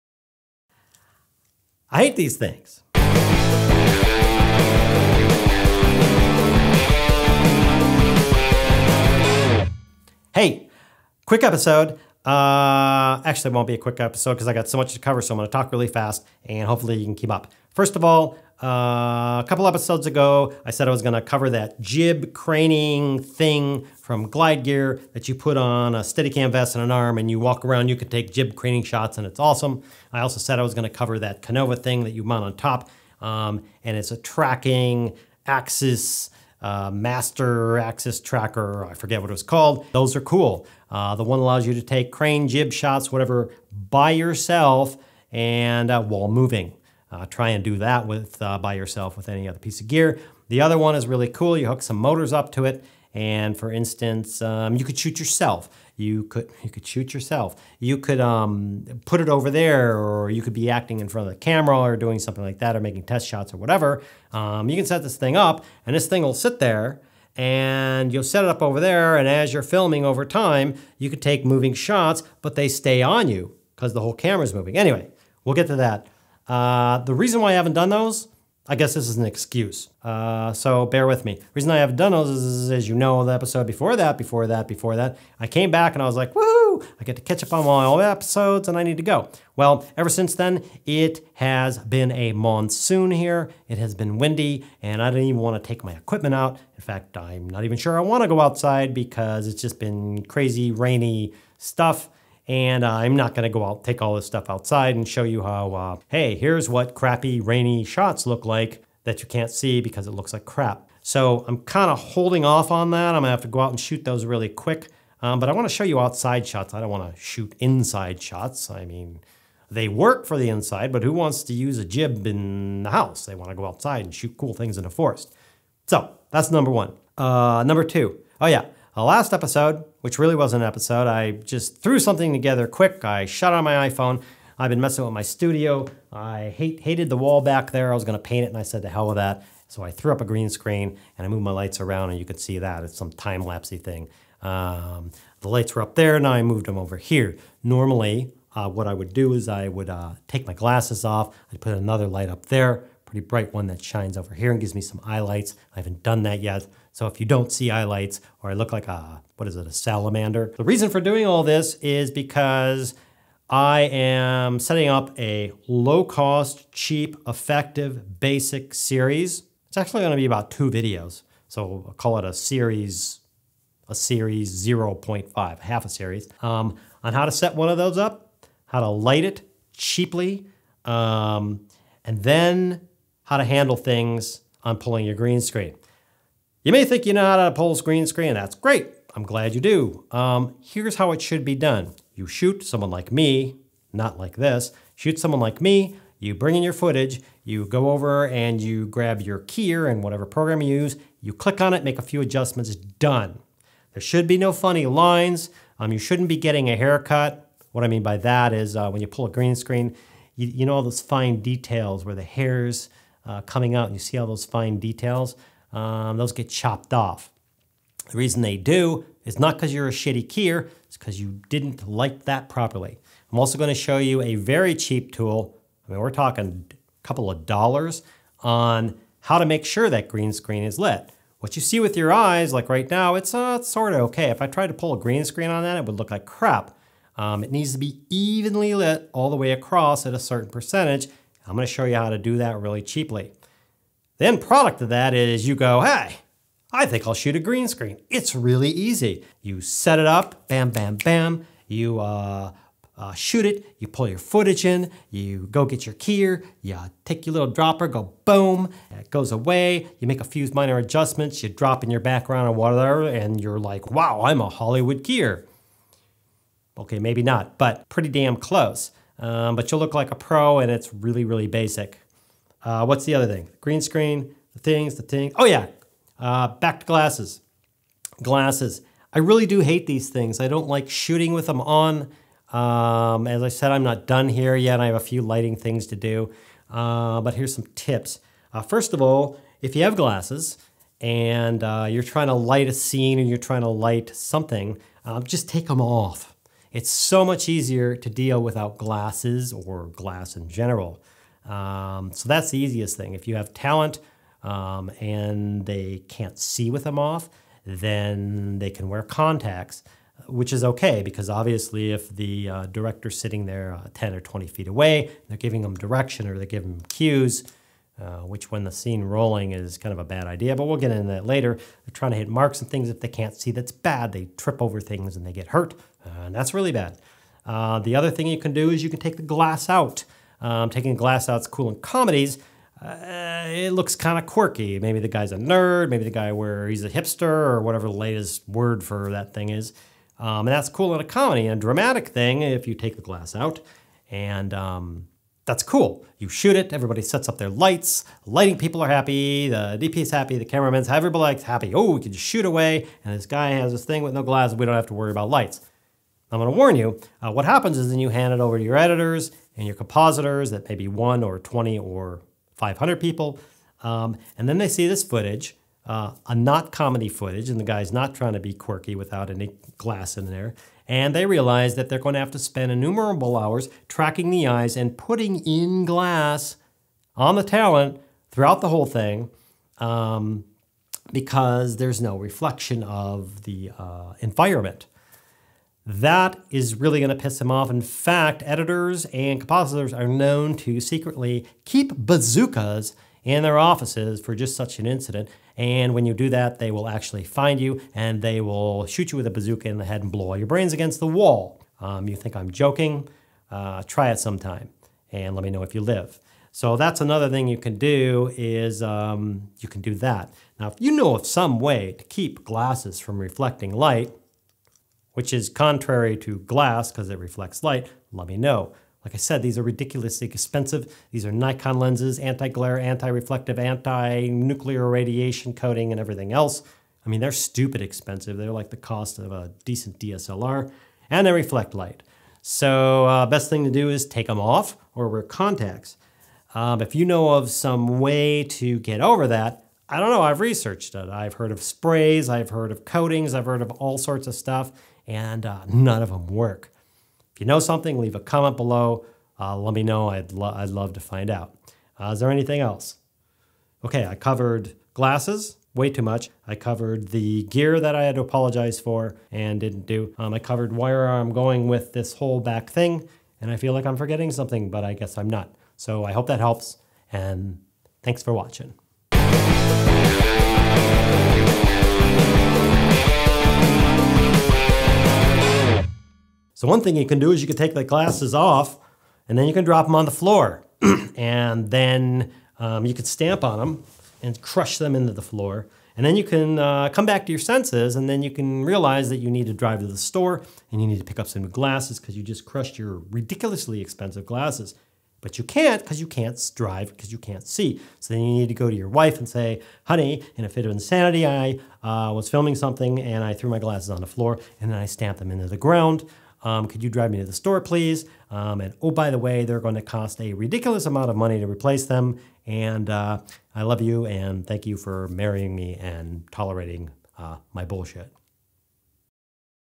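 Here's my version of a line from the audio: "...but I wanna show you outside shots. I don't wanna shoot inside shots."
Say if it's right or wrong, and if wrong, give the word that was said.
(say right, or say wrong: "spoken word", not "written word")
right.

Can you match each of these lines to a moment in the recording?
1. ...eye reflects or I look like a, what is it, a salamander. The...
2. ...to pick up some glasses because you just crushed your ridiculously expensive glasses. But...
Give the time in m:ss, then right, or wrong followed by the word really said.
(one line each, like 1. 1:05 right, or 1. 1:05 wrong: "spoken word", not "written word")
1. 2:37 wrong: "lights", not "reflects"
2. 8:10 right.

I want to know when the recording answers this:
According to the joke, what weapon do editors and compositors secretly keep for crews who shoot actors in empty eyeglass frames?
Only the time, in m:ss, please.
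6:31.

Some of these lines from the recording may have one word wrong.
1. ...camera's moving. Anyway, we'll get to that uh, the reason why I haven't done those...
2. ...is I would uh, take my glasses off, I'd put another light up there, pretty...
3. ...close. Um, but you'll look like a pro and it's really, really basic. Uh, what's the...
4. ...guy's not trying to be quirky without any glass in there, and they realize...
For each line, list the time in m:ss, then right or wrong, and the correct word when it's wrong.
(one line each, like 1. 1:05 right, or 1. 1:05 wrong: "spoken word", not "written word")
1. 1:14 right
2. 2:29 right
3. 4:28 right
4. 6:07 right.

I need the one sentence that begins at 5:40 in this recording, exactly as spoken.
Um, and that's cool in a comedy.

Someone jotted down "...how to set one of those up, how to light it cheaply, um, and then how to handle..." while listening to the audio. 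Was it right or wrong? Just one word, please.
right.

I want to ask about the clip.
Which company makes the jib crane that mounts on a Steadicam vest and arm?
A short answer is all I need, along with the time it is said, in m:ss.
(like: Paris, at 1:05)
Glide Gear, at 0:24.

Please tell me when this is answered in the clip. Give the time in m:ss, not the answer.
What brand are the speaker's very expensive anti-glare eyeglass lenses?
7:01.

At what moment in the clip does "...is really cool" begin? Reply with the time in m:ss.
0:50.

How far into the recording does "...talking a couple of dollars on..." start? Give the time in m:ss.
3:46.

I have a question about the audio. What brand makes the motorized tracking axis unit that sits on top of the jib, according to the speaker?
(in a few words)
Konova.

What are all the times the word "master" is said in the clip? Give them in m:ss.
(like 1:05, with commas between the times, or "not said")
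0:36.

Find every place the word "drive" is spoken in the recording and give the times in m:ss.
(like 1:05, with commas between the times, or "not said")
8:09, 8:16, 8:26.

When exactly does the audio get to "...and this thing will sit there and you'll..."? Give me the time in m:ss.
1:05.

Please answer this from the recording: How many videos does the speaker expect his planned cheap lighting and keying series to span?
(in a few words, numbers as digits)
2.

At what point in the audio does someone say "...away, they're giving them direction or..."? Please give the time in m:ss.
5:14.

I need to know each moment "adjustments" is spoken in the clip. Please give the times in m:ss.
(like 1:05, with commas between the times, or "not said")
3:22, 4:20.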